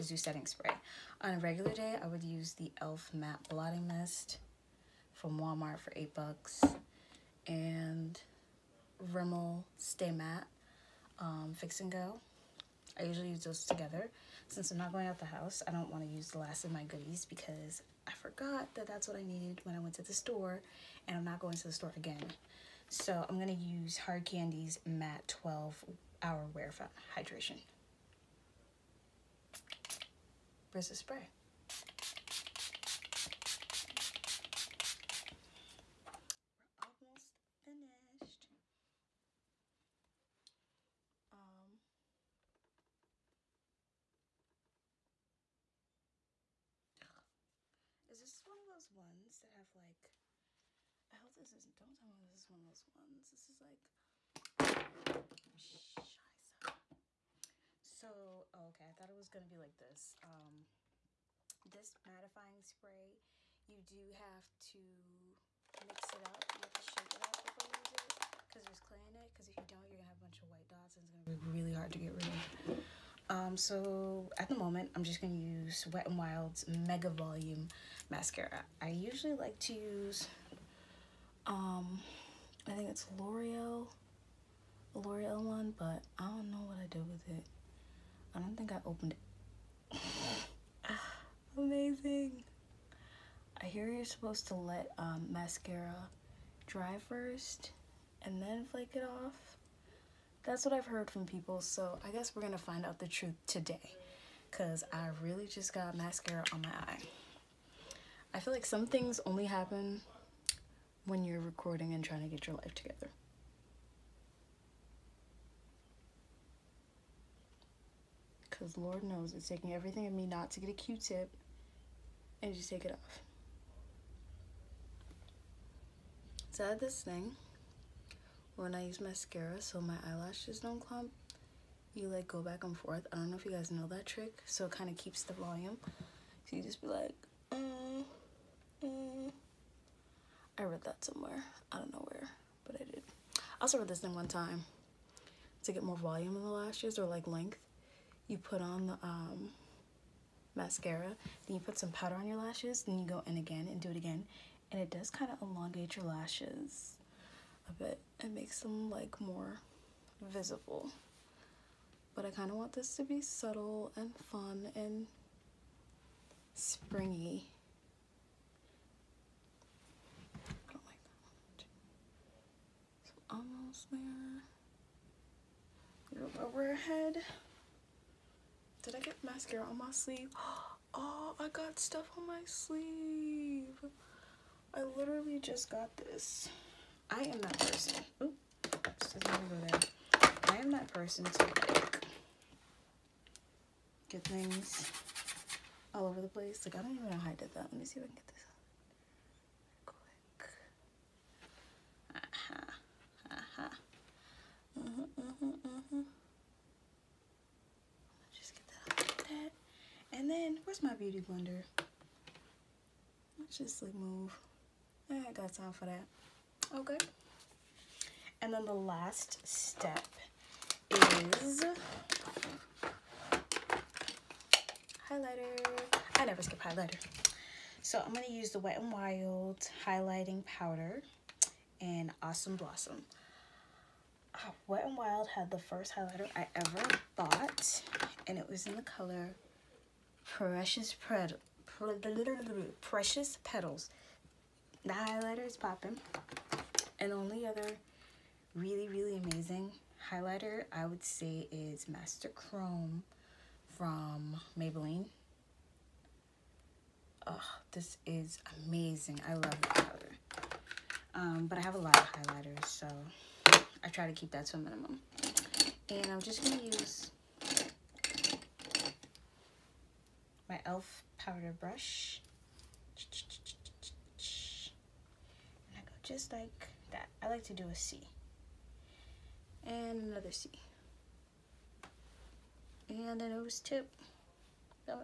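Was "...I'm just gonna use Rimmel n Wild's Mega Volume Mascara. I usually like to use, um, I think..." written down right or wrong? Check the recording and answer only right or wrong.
wrong.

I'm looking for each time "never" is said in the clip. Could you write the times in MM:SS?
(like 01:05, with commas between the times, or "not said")
03:46.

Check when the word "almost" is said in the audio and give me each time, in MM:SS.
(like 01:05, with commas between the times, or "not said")
00:37, 02:53.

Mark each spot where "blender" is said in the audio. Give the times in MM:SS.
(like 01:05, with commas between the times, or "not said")
03:31.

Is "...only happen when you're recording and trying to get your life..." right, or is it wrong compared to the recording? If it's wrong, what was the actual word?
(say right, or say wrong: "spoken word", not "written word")
right.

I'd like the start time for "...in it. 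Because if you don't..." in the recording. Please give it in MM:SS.
01:09.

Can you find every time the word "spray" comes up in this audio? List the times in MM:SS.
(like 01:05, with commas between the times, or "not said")
00:00, 00:30, 01:02.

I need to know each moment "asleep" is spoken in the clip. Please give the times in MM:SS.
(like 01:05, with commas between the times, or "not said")
not said.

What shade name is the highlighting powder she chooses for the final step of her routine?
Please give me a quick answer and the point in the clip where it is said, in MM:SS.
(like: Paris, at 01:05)
Awesome Blossom, at 03:52.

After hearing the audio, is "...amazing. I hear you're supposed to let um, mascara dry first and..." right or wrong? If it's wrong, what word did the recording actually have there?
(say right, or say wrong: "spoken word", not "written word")
right.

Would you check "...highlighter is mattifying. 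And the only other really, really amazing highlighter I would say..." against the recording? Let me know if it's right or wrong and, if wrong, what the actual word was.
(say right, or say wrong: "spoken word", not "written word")
wrong: "popping", not "mattifying".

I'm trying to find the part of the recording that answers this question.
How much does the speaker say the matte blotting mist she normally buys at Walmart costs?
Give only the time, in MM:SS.
00:05.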